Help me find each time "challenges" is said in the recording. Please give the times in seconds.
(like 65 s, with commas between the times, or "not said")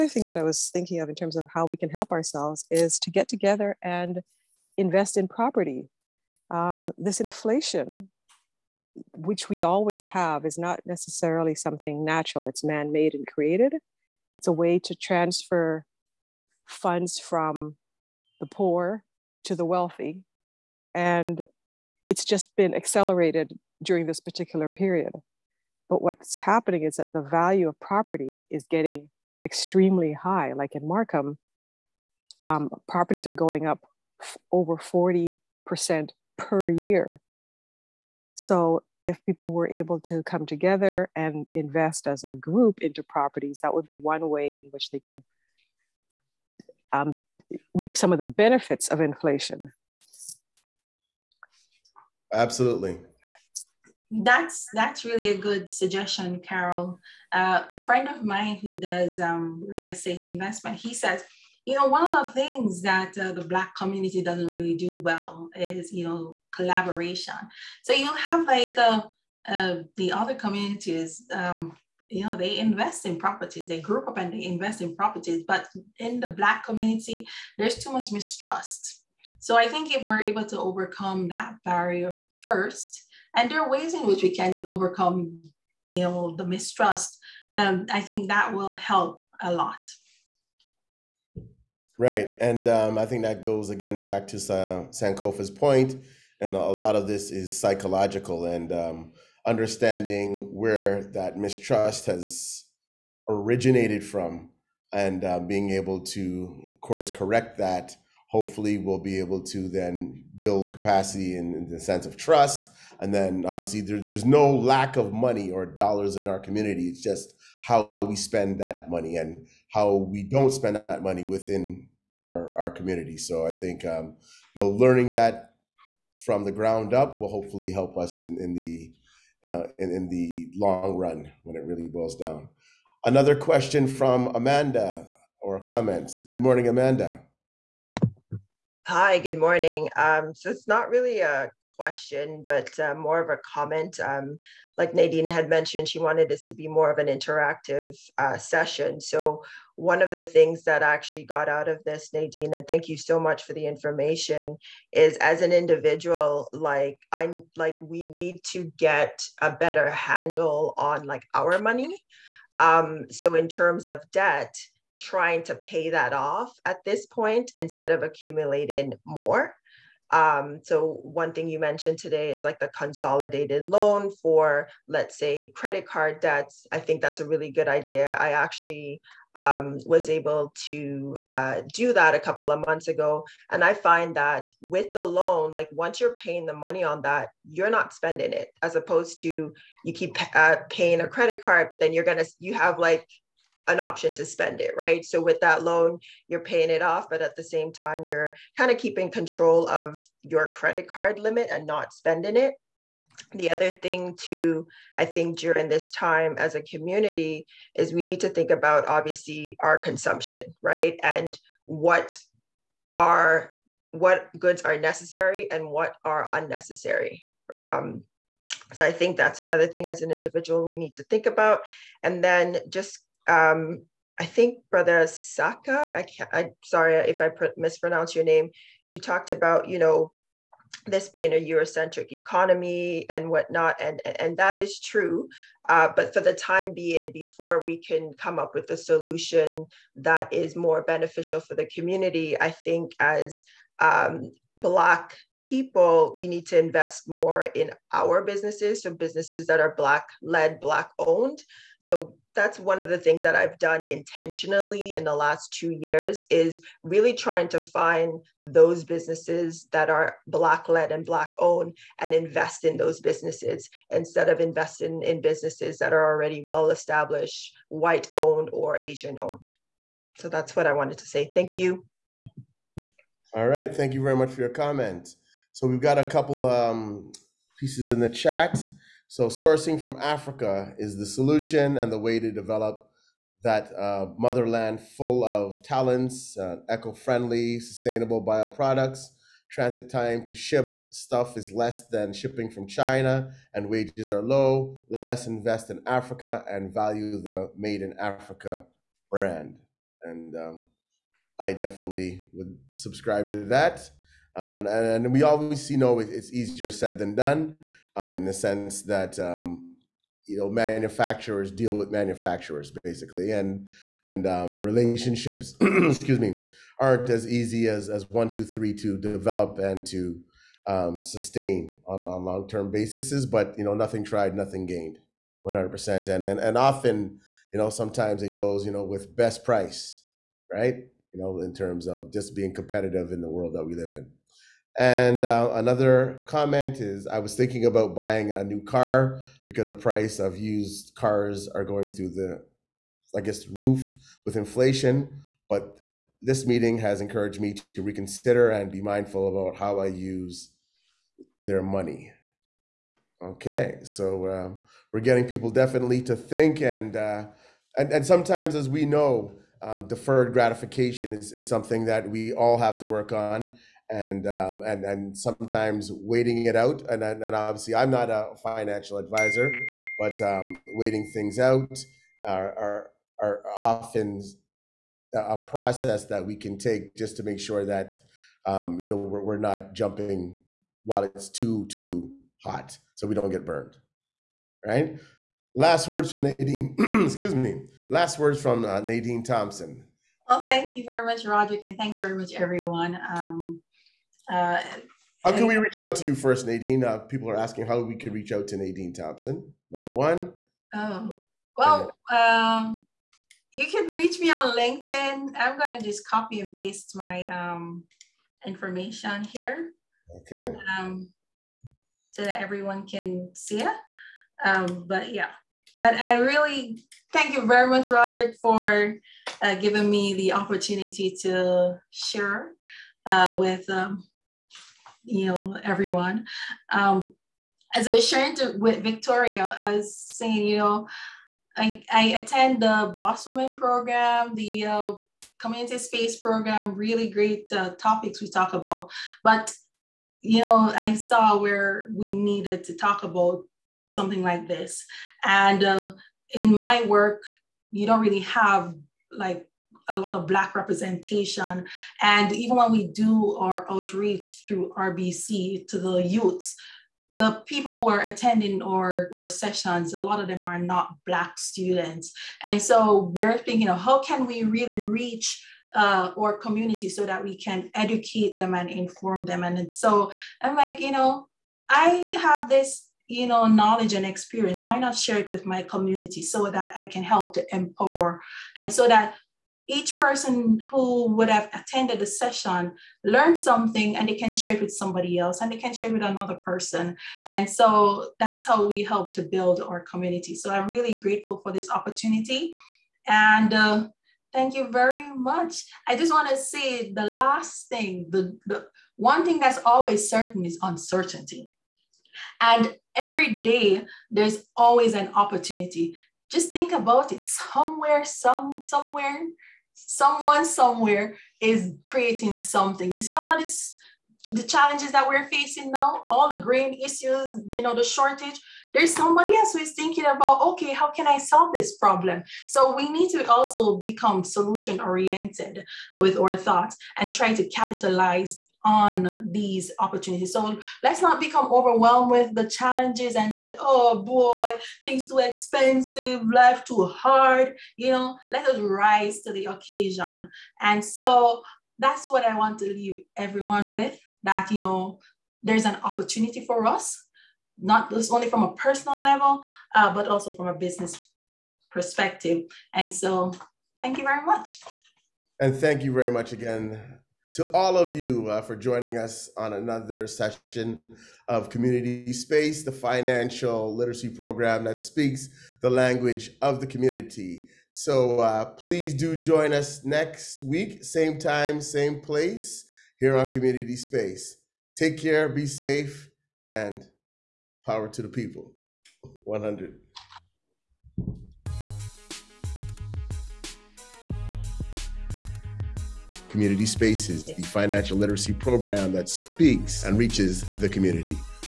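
514 s, 532 s.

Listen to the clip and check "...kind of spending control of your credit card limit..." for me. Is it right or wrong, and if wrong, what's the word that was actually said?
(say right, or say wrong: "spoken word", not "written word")
wrong: "keeping", not "spending".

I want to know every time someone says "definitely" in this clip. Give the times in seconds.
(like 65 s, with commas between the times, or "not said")
301 s, 355 s.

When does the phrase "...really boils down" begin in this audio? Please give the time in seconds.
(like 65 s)
131 s.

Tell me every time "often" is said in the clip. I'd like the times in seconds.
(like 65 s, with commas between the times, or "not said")
326 s, 373 s.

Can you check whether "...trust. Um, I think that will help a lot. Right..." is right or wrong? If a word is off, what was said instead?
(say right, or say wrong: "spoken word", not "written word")
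wrong: "mistrust", not "trust".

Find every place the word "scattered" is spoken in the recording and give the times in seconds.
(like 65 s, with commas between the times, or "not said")
not said.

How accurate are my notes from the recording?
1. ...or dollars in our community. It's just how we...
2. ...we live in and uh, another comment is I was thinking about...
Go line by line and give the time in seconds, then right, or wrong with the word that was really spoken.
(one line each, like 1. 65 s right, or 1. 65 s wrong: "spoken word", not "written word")
1. 115 s right
2. 333 s right.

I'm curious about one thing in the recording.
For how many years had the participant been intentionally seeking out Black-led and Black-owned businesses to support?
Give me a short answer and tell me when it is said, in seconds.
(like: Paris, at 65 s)
2, at 255 s.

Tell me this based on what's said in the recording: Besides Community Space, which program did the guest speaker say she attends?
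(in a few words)
Boss Women program.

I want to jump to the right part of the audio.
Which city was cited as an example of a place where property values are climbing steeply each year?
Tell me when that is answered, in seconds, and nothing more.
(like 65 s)
30 s.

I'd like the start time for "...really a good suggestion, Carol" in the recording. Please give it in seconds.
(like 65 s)
55 s.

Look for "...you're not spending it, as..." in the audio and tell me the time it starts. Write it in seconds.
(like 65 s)
187 s.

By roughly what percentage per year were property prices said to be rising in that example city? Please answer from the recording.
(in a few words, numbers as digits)
40%.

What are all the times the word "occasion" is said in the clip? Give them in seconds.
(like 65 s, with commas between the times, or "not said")
539 s.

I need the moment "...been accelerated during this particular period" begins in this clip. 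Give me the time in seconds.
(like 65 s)
22 s.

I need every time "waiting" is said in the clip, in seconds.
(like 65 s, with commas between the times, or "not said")
365 s, 370 s.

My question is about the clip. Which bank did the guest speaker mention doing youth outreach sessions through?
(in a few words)
RBC.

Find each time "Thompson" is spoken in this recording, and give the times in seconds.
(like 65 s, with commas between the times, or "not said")
389 s, 398 s.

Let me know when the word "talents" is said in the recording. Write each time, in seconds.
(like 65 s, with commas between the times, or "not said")
285 s.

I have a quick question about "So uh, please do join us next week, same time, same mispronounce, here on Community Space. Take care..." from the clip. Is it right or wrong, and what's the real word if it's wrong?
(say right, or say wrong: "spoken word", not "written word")
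wrong: "place", not "mispronounce".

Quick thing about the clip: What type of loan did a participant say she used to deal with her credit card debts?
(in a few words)
consolidated loan.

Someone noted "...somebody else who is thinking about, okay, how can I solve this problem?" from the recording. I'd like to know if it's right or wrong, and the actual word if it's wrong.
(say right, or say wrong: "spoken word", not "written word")
right.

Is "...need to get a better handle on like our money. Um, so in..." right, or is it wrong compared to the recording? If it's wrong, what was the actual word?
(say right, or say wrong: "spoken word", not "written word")
right.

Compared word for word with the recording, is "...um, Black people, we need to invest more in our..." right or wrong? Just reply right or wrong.
right.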